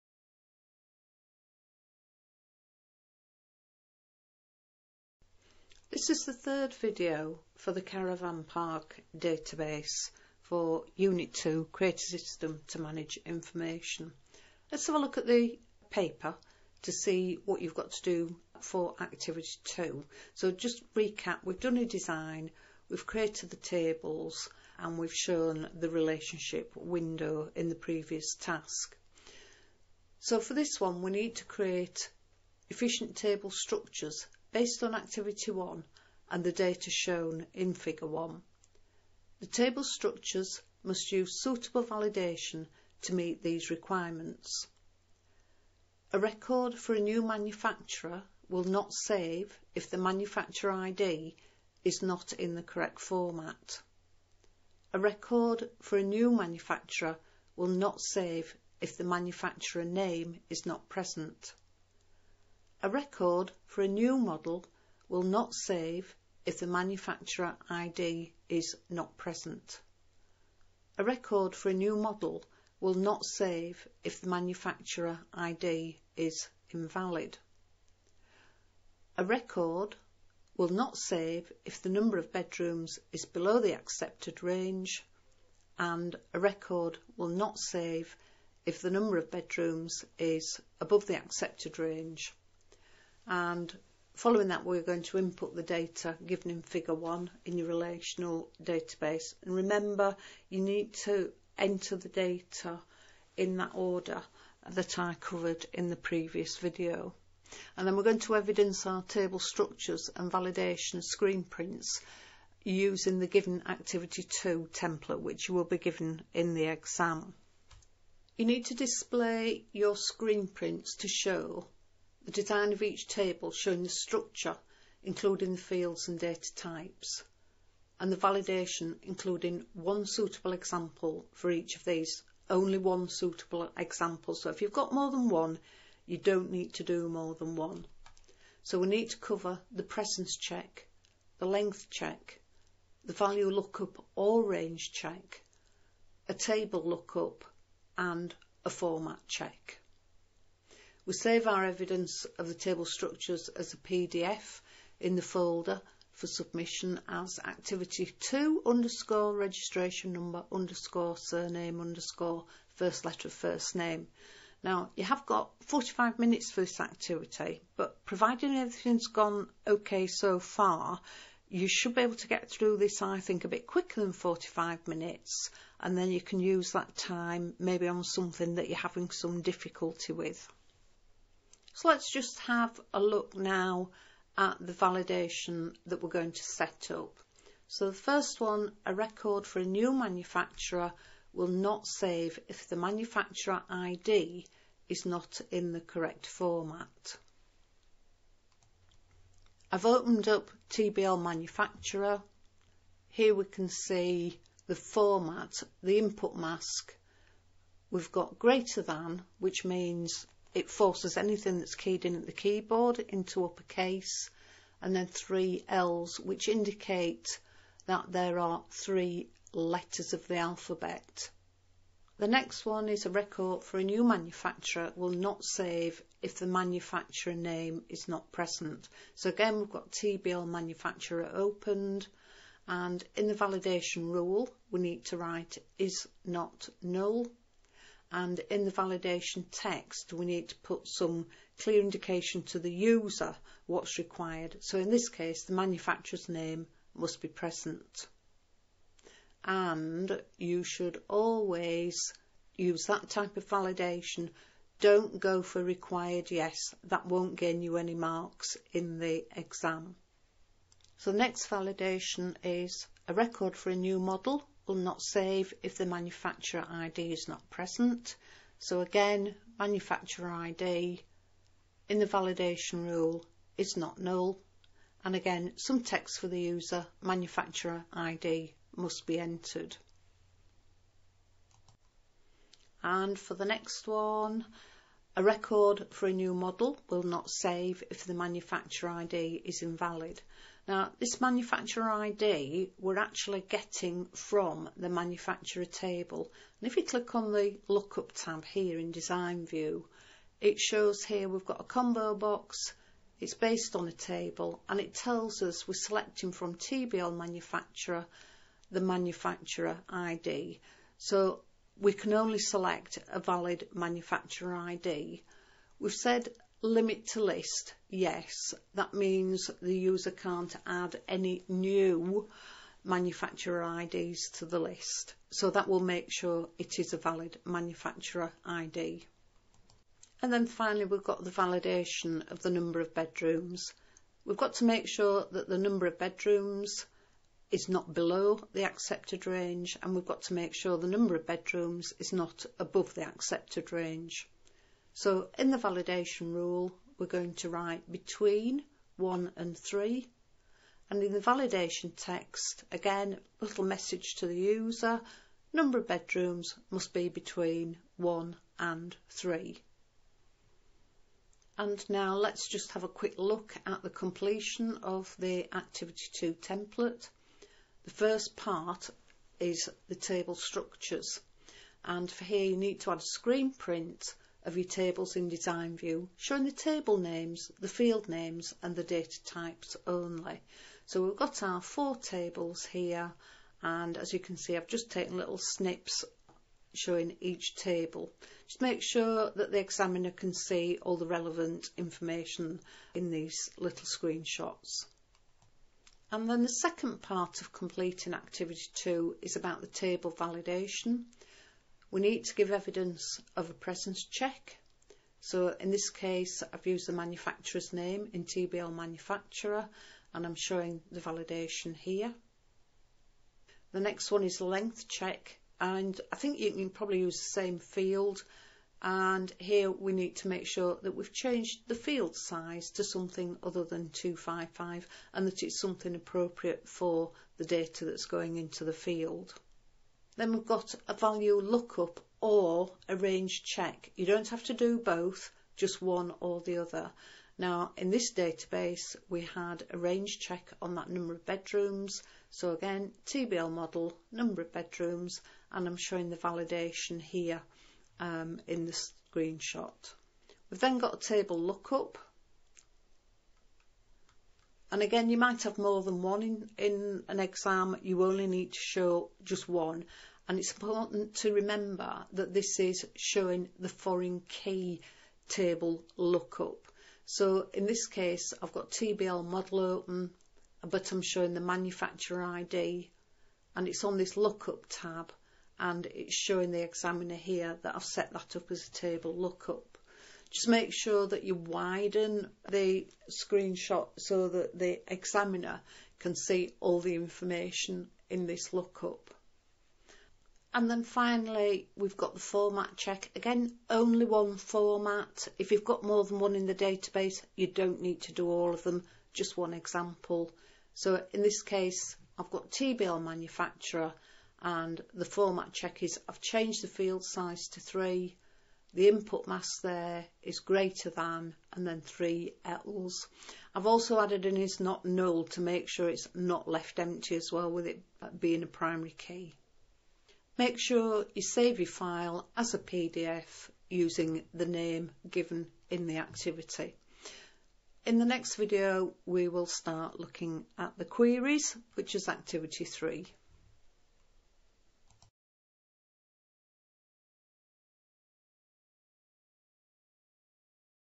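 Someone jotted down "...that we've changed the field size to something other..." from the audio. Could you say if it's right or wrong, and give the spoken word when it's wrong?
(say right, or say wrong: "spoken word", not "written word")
right.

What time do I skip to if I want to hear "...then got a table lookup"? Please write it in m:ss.
7:30.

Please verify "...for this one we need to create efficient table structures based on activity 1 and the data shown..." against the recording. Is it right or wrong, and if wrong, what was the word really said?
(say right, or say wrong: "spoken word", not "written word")
right.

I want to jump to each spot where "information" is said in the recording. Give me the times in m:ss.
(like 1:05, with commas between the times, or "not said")
0:13, 6:31, 8:06.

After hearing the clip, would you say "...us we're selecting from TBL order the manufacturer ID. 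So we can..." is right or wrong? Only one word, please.
wrong.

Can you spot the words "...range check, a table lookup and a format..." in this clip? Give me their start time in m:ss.
2:24.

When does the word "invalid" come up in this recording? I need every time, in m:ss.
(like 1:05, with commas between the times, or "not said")
1:16, 4:49.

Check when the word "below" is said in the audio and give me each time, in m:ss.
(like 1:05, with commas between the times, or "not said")
1:23, 5:37.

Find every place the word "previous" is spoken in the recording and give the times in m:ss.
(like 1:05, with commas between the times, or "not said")
0:27, 1:45.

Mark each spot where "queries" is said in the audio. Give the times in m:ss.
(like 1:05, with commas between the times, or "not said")
8:50.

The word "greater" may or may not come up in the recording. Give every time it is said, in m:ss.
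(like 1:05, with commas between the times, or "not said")
3:28, 8:30.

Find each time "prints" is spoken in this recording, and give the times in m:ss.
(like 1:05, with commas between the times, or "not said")
1:51, 2:00, 6:13.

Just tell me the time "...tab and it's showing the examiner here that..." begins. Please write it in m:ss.
7:54.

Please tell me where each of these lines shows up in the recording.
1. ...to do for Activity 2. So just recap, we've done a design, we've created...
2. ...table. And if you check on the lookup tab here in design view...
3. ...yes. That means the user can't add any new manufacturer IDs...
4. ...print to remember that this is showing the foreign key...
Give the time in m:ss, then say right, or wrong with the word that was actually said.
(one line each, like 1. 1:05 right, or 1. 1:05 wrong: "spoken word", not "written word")
1. 0:17 right
2. 4:55 wrong: "click", not "check"
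3. 5:17 right
4. 7:40 wrong: "important", not "print".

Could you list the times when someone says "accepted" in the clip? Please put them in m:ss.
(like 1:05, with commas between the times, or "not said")
1:23, 1:31, 5:38, 5:43.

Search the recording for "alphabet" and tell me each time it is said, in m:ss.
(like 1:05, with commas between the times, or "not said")
3:40.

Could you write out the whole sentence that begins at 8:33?
I've also added an is not null to make sure it's not left empty as well with it being a primary key.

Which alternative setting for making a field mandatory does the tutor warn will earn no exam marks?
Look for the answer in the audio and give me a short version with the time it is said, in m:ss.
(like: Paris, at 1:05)
required yes, at 4:15.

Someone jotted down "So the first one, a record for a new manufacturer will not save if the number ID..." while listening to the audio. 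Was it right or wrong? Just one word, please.
wrong.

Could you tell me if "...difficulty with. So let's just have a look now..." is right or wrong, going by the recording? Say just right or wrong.
right.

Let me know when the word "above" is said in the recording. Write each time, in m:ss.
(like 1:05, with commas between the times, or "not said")
1:30, 5:42.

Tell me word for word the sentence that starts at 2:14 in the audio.
So if you've got more than one, you don't need to do more than one.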